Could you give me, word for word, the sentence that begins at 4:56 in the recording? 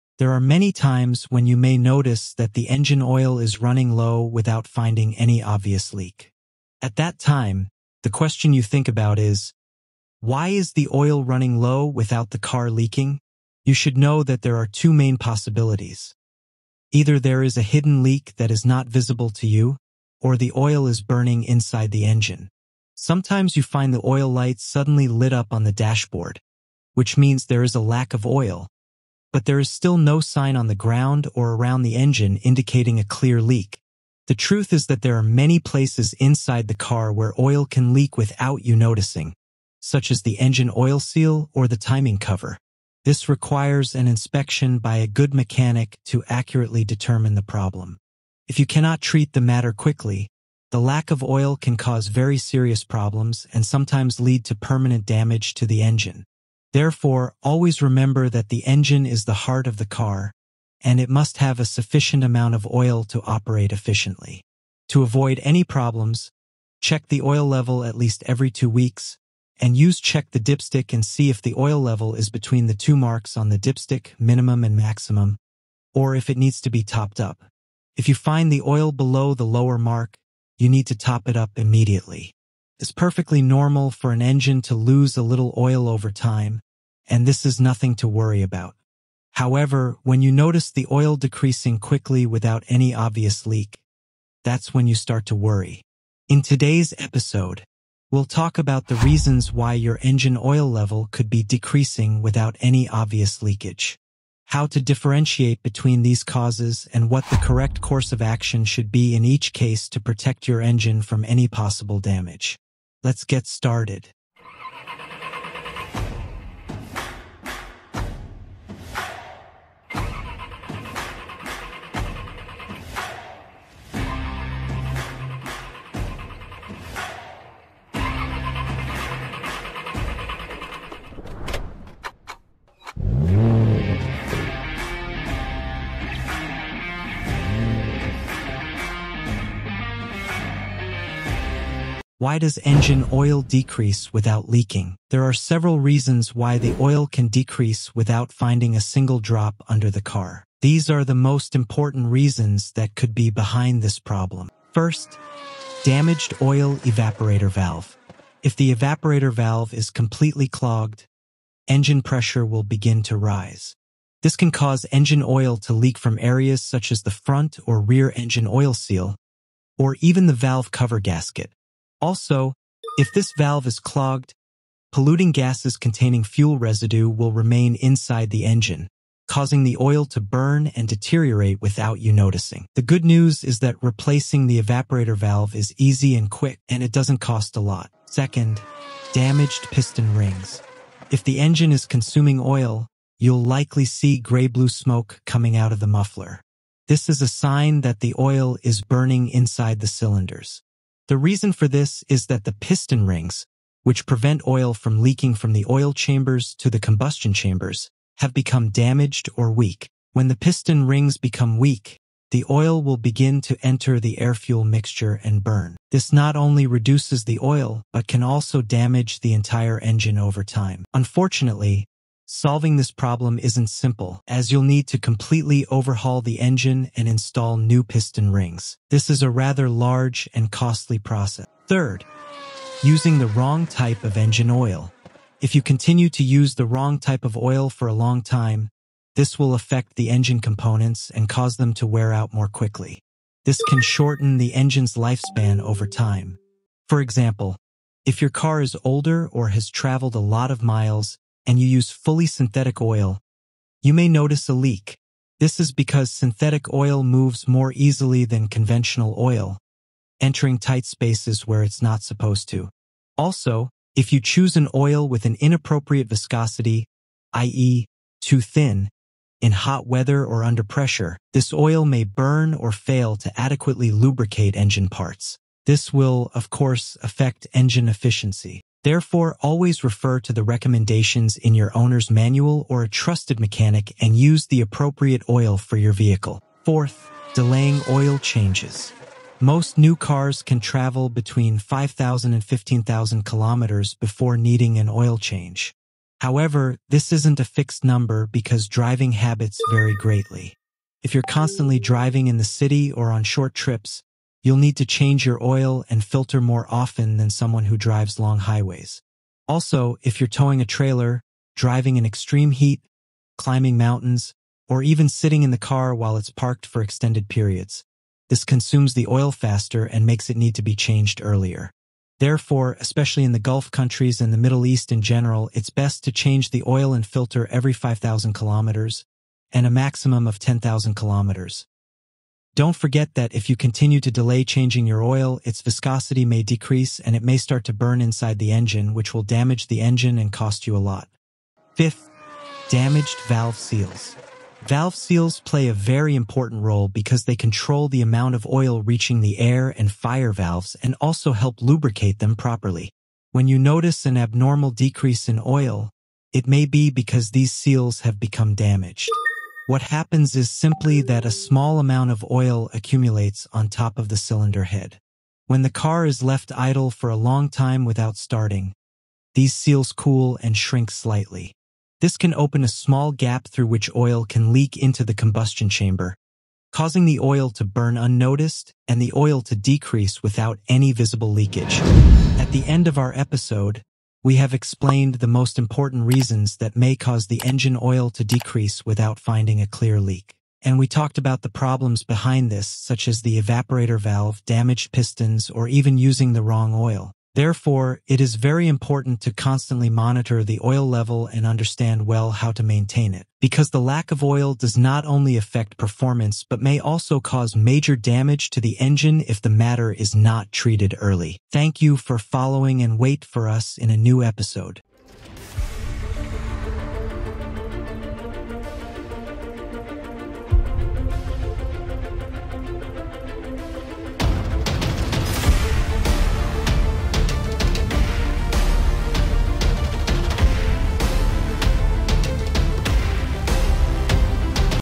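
However, this isn't a fixed number because driving habits vary greatly.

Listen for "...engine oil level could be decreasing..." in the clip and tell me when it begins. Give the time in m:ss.
1:40.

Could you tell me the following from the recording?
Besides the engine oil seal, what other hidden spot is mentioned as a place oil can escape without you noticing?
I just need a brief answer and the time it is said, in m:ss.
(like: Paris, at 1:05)
timing cover, at 0:41.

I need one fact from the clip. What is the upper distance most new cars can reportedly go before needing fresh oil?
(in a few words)
15,000 kilometers.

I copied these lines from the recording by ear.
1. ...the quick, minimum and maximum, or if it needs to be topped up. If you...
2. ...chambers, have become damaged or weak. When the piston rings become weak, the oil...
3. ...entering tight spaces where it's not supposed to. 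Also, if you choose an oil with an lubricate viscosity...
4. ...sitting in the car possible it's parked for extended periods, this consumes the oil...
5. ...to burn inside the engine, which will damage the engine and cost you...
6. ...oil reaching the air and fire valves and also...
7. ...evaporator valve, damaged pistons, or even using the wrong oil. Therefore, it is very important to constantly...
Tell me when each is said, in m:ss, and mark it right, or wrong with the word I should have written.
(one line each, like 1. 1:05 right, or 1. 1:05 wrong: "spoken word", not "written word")
1. 1:13 wrong: "dipstick", not "quick"
2. 3:27 right
3. 4:20 wrong: "inappropriate", not "lubricate"
4. 5:15 wrong: "while", not "possible"
5. 5:37 right
6. 5:48 right
7. 6:33 right.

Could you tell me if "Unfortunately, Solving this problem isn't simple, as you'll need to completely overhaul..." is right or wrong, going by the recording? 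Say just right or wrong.
right.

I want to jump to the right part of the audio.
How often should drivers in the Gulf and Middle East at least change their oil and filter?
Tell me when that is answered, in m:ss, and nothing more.
5:27.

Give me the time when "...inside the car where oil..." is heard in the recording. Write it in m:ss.
0:36.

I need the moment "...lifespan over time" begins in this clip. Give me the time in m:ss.
4:04.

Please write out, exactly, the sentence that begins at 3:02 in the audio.
The good news is that replacing the evaporator valve is easy and quick, and it doesn't cost a lot.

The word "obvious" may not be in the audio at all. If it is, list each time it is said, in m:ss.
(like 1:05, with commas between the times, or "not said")
0:05, 1:32, 1:42.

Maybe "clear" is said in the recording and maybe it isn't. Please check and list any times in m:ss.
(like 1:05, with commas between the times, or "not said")
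0:33, 6:29.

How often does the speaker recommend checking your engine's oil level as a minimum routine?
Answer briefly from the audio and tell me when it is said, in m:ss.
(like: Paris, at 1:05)
every two weeks, at 1:08.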